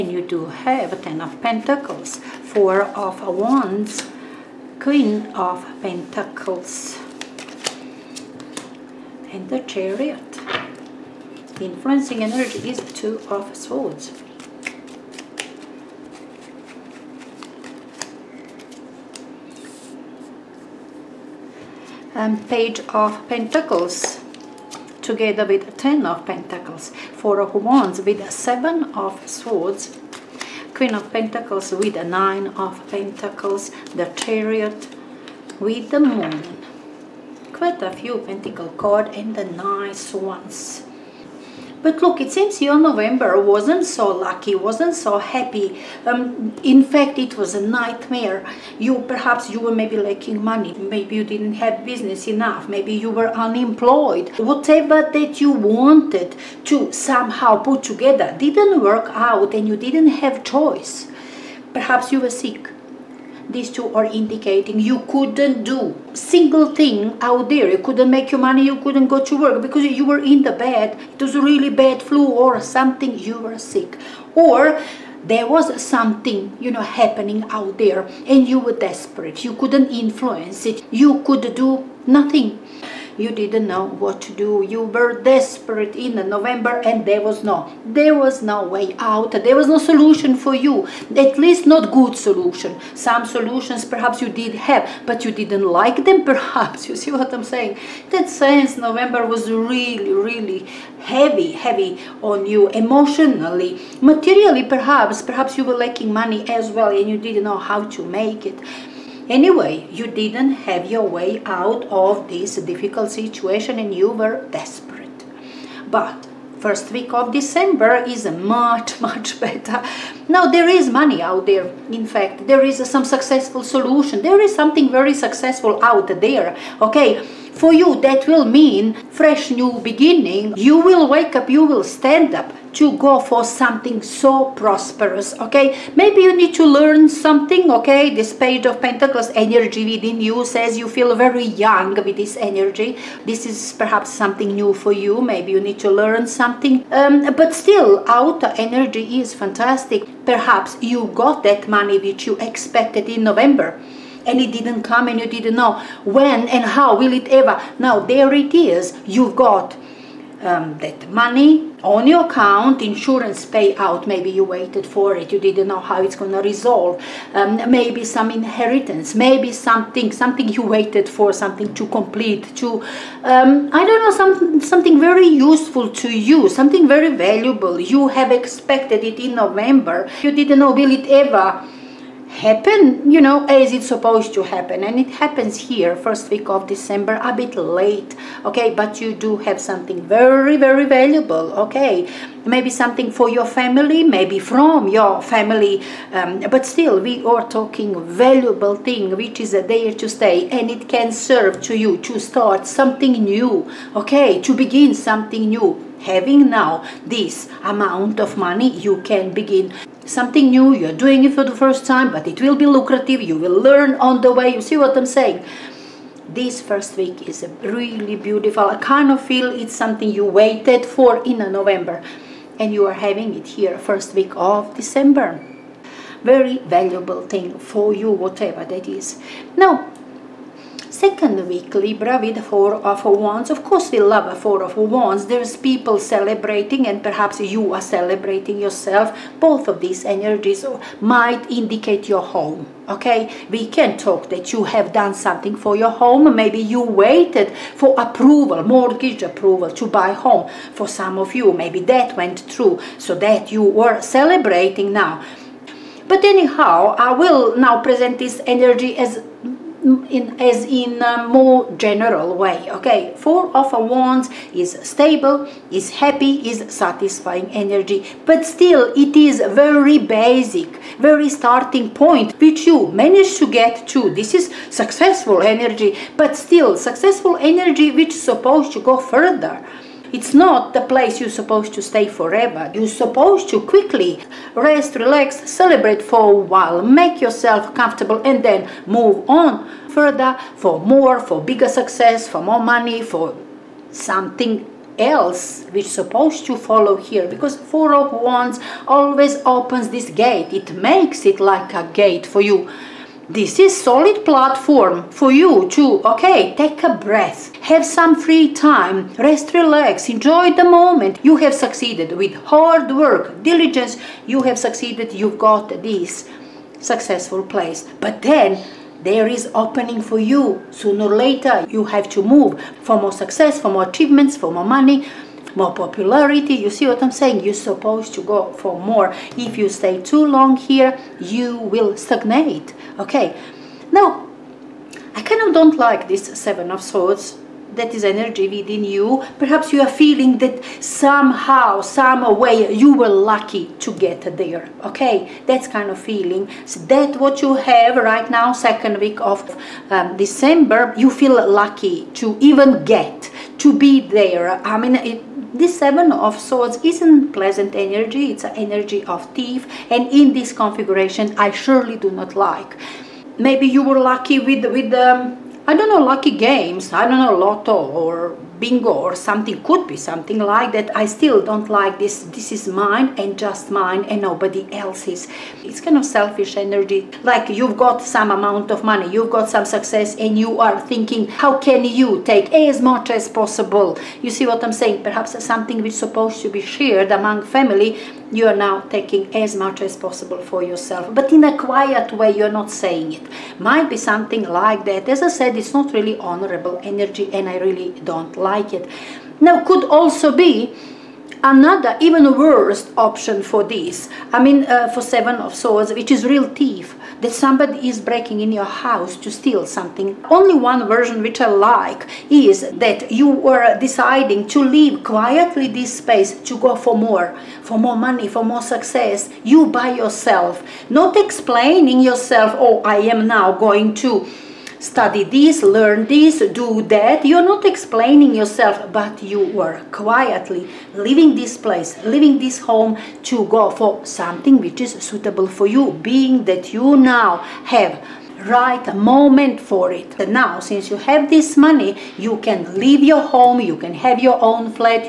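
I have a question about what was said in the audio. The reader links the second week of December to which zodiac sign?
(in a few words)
Libra.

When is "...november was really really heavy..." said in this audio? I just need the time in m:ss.
1:38.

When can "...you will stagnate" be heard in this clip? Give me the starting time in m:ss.
5:31.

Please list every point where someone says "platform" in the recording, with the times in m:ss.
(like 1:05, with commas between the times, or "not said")
5:04.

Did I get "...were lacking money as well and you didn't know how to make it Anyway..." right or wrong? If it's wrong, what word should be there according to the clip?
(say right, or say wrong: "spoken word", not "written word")
right.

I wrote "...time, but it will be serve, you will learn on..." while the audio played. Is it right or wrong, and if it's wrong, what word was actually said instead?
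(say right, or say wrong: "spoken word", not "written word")
wrong: "lucrative", not "serve".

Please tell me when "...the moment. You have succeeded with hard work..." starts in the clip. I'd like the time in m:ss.
5:10.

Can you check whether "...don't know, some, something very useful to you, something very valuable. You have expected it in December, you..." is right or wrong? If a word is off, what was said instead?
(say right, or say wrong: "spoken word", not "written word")
wrong: "November", not "December".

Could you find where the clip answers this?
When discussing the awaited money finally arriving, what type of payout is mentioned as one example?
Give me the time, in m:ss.
2:42.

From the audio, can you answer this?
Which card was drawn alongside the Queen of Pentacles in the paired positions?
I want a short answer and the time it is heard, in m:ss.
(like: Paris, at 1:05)
Nine of Pentacles, at 0:32.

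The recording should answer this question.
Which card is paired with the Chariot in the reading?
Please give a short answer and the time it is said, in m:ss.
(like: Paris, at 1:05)
The Moon, at 0:35.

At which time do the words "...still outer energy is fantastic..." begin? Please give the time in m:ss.
2:27.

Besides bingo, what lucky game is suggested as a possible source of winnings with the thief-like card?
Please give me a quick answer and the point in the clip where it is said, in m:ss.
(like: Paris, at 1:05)
Lotto, at 6:07.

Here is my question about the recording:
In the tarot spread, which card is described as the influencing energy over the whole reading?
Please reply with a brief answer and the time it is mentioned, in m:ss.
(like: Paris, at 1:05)
Two of Swords, at 0:12.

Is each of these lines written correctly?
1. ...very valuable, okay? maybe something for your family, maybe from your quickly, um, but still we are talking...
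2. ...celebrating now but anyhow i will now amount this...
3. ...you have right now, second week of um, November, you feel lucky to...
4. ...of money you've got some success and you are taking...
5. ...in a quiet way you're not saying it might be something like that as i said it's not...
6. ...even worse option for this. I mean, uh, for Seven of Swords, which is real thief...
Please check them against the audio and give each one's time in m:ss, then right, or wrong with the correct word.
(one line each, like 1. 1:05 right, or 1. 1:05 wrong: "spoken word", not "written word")
1. 3:10 wrong: "family", not "quickly"
2. 4:14 wrong: "present", not "amount"
3. 5:47 wrong: "December", not "November"
4. 6:18 wrong: "thinking", not "taking"
5. 6:31 right
6. 6:42 right.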